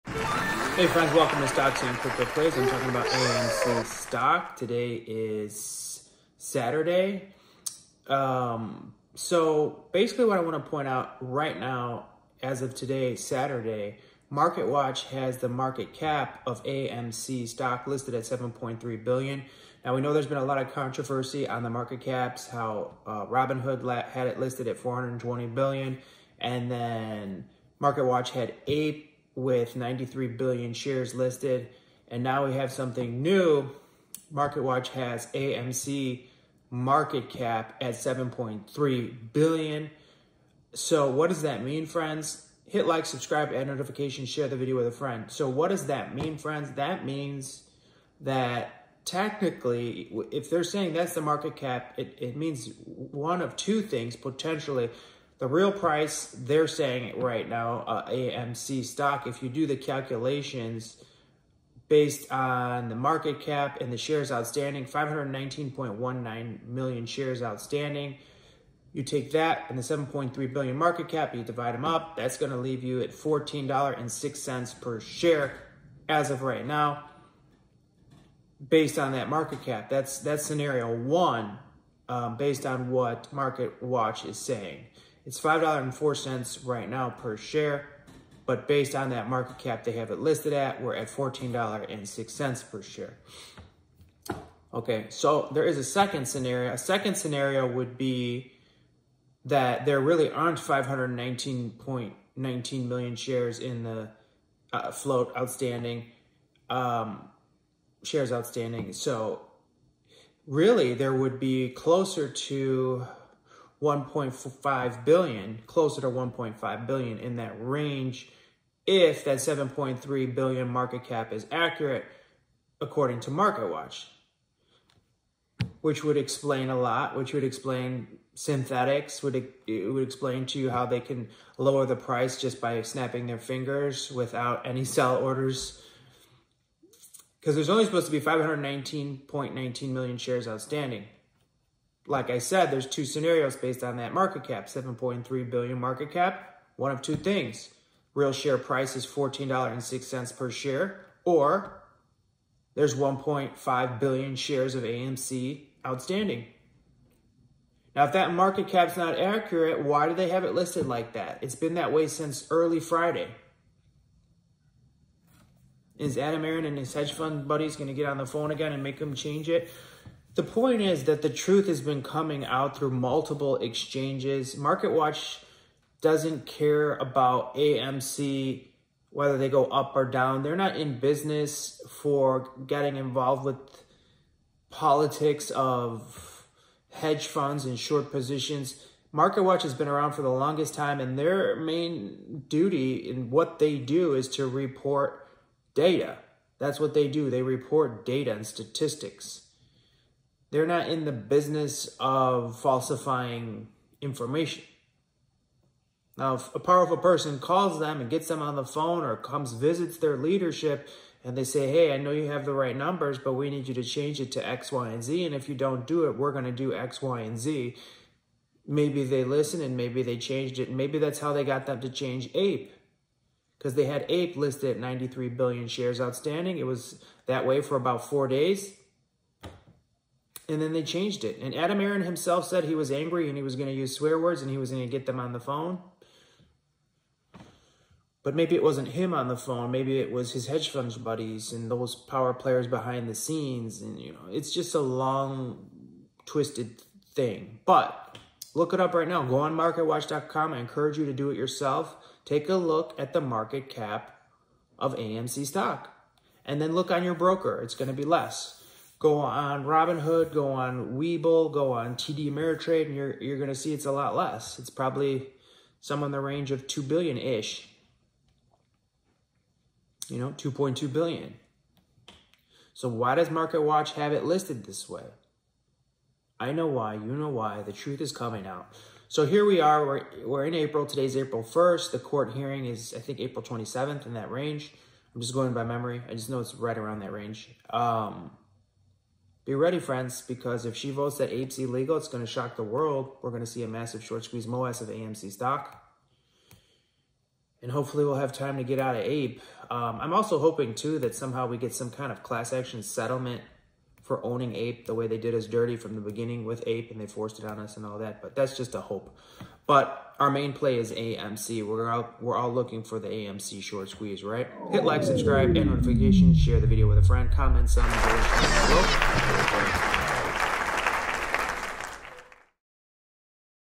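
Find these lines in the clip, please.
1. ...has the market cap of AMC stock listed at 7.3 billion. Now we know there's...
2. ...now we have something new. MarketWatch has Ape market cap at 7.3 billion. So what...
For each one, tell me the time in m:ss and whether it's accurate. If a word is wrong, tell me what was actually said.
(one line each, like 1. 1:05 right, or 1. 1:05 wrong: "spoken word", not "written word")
1. 0:15 right
2. 0:32 wrong: "AMC", not "Ape".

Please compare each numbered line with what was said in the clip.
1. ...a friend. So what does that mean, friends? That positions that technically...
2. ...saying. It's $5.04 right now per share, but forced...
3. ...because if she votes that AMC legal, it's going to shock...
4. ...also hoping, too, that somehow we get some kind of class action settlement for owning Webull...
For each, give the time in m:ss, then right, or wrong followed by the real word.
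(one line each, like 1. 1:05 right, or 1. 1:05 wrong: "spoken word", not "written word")
1. 0:44 wrong: "means", not "positions"
2. 1:24 wrong: "based", not "forced"
3. 4:50 right
4. 5:00 wrong: "Ape", not "Webull".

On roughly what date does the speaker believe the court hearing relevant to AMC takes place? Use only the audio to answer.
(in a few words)
April 27th.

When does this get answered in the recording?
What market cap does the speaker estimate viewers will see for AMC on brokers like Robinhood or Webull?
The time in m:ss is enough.
4:30.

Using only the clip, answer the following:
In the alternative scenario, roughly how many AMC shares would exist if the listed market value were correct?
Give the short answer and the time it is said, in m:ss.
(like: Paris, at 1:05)
1.5 billion, at 2:32.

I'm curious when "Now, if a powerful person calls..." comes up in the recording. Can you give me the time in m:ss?
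3:26.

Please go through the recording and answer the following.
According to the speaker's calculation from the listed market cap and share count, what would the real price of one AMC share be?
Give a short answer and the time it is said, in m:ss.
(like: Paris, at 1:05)
$14.06, at 1:13.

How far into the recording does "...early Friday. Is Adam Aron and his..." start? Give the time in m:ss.
2:42.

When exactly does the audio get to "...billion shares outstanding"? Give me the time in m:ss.
3:45.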